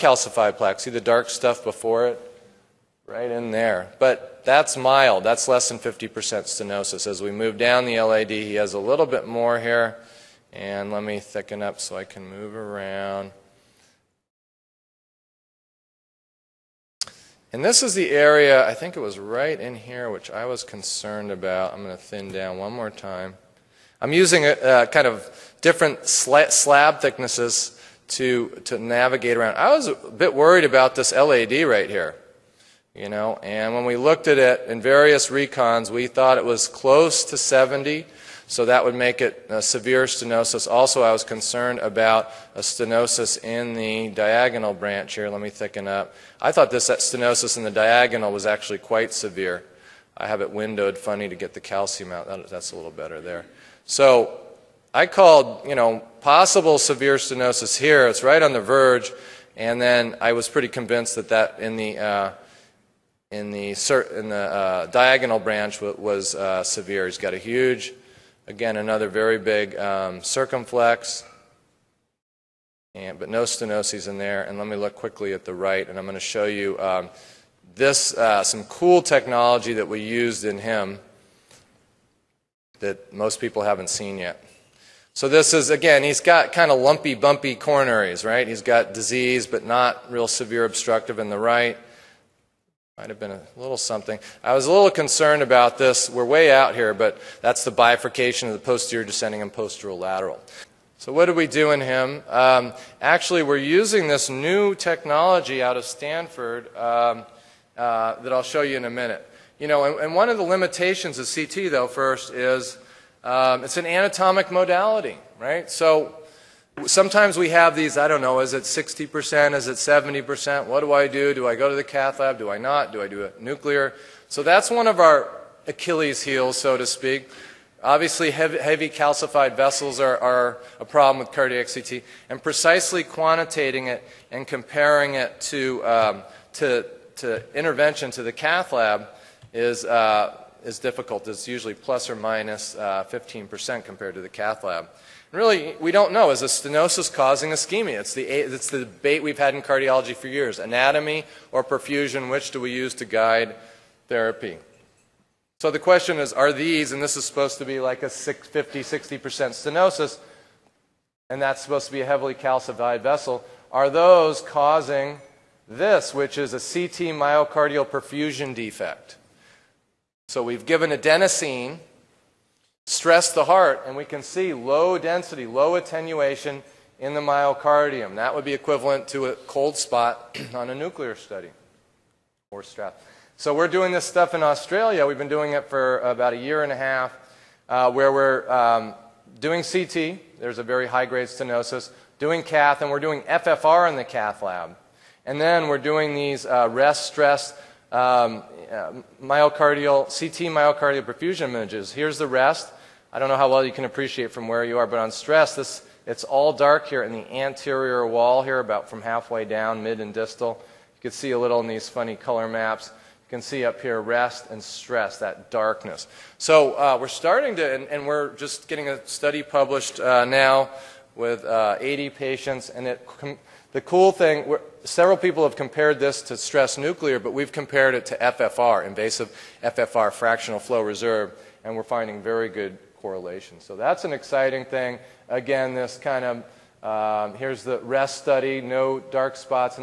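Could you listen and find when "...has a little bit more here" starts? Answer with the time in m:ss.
0:08.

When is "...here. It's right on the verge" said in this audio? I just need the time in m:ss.
0:57.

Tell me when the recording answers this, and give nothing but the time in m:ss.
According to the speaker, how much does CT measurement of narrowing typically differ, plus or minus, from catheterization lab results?
2:23.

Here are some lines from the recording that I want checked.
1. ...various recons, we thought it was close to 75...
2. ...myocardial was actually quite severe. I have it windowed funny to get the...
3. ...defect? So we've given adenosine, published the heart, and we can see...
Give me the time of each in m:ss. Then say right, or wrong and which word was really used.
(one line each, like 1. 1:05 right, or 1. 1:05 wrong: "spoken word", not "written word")
1. 0:34 wrong: "70", not "75"
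2. 0:47 wrong: "diagonal", not "myocardial"
3. 2:48 wrong: "stressed", not "published".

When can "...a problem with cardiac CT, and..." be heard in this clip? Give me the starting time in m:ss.
2:10.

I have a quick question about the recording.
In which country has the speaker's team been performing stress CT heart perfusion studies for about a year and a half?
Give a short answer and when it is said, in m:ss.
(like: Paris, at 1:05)
Australia, at 3:04.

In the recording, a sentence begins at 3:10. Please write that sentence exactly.
There's a very high grade stenosis.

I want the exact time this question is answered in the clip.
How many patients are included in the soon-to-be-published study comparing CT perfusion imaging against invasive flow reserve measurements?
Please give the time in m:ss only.
3:41.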